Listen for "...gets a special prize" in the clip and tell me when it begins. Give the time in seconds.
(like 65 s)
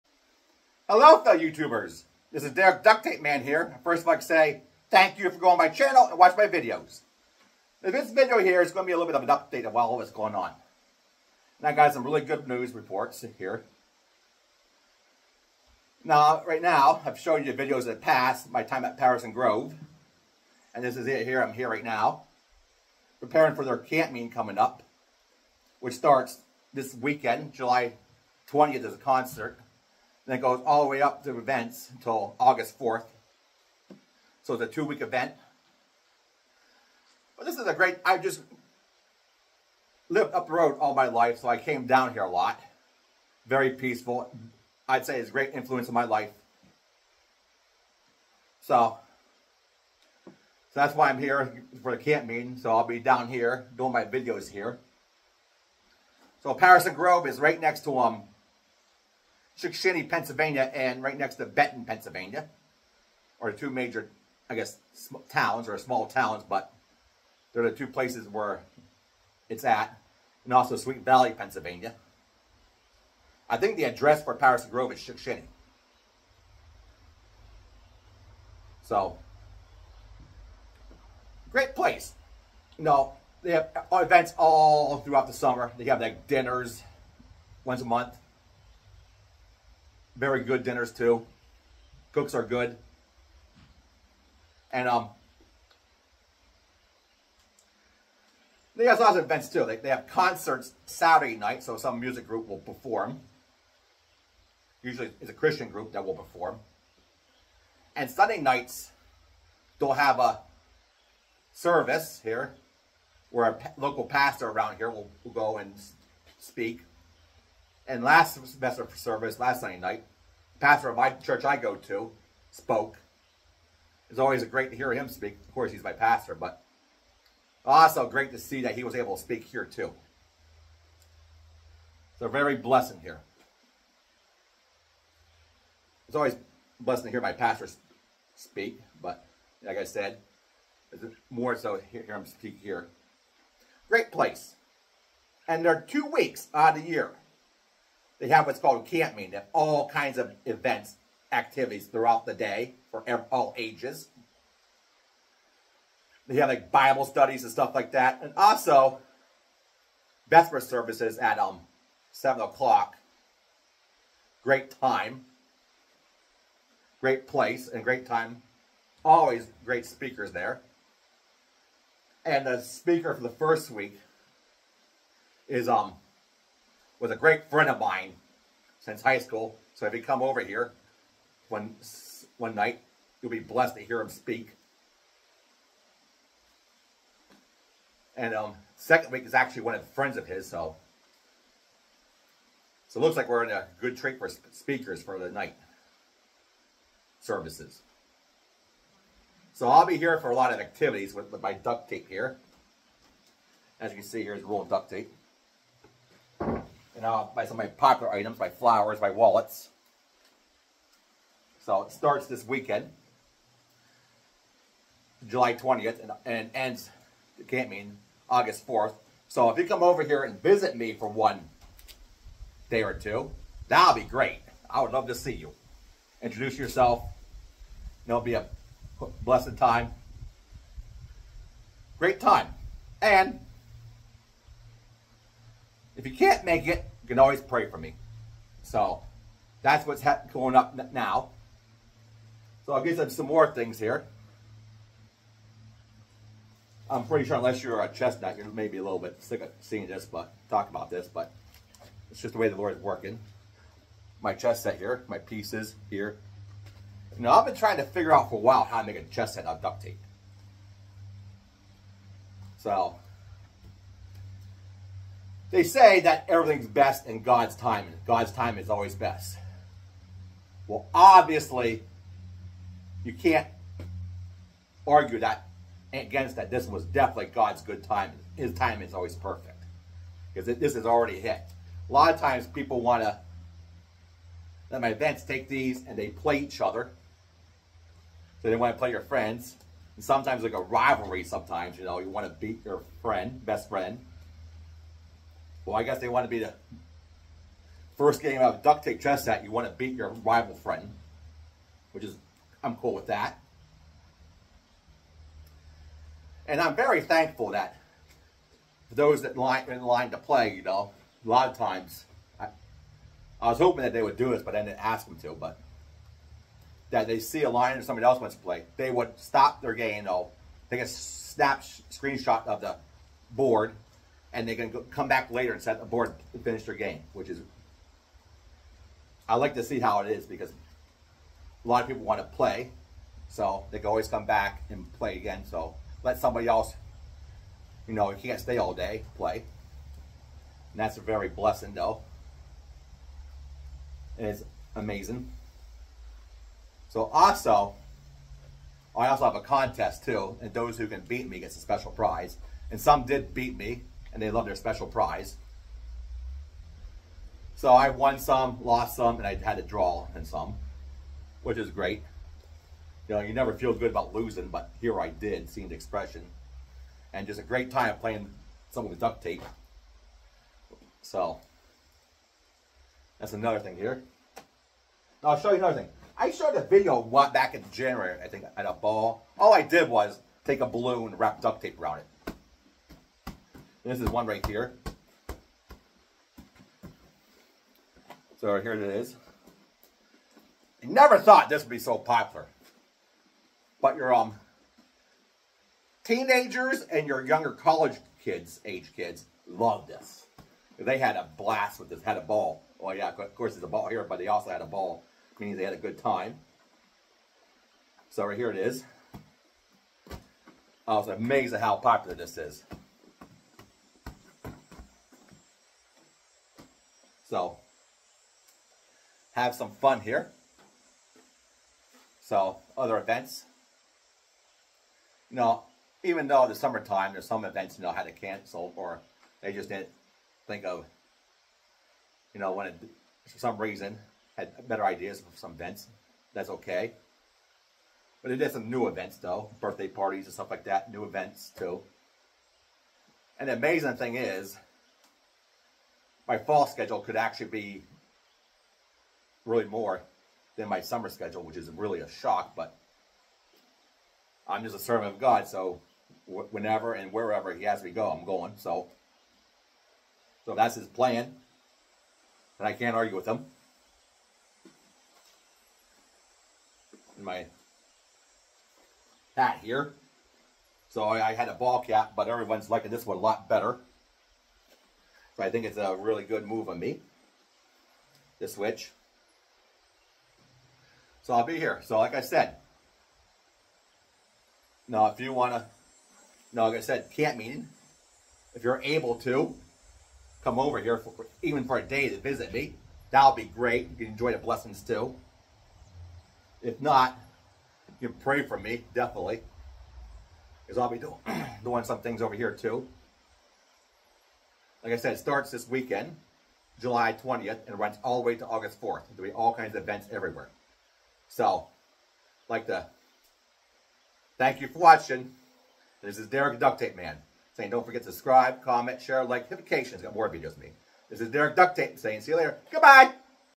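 351 s.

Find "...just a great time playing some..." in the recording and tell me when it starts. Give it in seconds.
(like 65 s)
367 s.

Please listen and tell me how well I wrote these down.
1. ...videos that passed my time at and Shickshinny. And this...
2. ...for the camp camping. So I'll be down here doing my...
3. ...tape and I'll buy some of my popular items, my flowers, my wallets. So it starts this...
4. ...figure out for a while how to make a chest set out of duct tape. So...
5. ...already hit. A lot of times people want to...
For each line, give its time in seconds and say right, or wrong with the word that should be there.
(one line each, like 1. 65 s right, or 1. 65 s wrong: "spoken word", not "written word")
1. 17 s wrong: "Grove", not "Shickshinny"
2. 51 s wrong: "meeting", not "camping"
3. 204 s right
4. 257 s right
5. 280 s right.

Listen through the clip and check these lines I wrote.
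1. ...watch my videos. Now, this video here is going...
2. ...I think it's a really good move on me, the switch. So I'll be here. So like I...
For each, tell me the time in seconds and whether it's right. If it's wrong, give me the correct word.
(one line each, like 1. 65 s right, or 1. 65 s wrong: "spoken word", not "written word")
1. 6 s right
2. 475 s right.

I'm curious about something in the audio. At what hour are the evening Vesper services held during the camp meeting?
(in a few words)
7 o'clock.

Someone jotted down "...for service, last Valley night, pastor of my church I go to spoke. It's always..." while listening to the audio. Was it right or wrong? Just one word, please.
wrong.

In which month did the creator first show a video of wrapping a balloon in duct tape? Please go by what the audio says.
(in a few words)
January.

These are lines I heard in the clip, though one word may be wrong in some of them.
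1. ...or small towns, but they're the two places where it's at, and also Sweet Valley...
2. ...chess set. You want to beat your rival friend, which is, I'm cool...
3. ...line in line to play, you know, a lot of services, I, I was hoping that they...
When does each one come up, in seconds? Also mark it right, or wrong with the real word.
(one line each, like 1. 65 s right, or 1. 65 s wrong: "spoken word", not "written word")
1. 65 s right
2. 298 s right
3. 309 s wrong: "times", not "services".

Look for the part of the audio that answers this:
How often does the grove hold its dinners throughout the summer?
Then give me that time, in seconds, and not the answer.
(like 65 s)
87 s.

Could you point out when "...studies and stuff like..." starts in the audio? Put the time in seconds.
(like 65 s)
157 s.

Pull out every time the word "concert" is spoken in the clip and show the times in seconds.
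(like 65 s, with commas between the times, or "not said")
28 s, 100 s.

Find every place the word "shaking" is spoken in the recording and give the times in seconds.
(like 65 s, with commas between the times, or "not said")
not said.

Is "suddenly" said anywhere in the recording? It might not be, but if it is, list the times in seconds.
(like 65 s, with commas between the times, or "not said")
not said.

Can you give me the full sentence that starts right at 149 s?
They have all kinds of events, activities throughout the day for all ages.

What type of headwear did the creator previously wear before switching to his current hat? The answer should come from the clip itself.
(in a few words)
A ball cap.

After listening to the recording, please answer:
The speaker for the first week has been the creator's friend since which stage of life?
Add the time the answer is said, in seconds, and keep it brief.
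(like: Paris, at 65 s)
High school, at 179 s.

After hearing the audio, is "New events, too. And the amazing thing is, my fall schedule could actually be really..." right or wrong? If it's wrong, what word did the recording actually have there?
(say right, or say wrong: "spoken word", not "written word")
right.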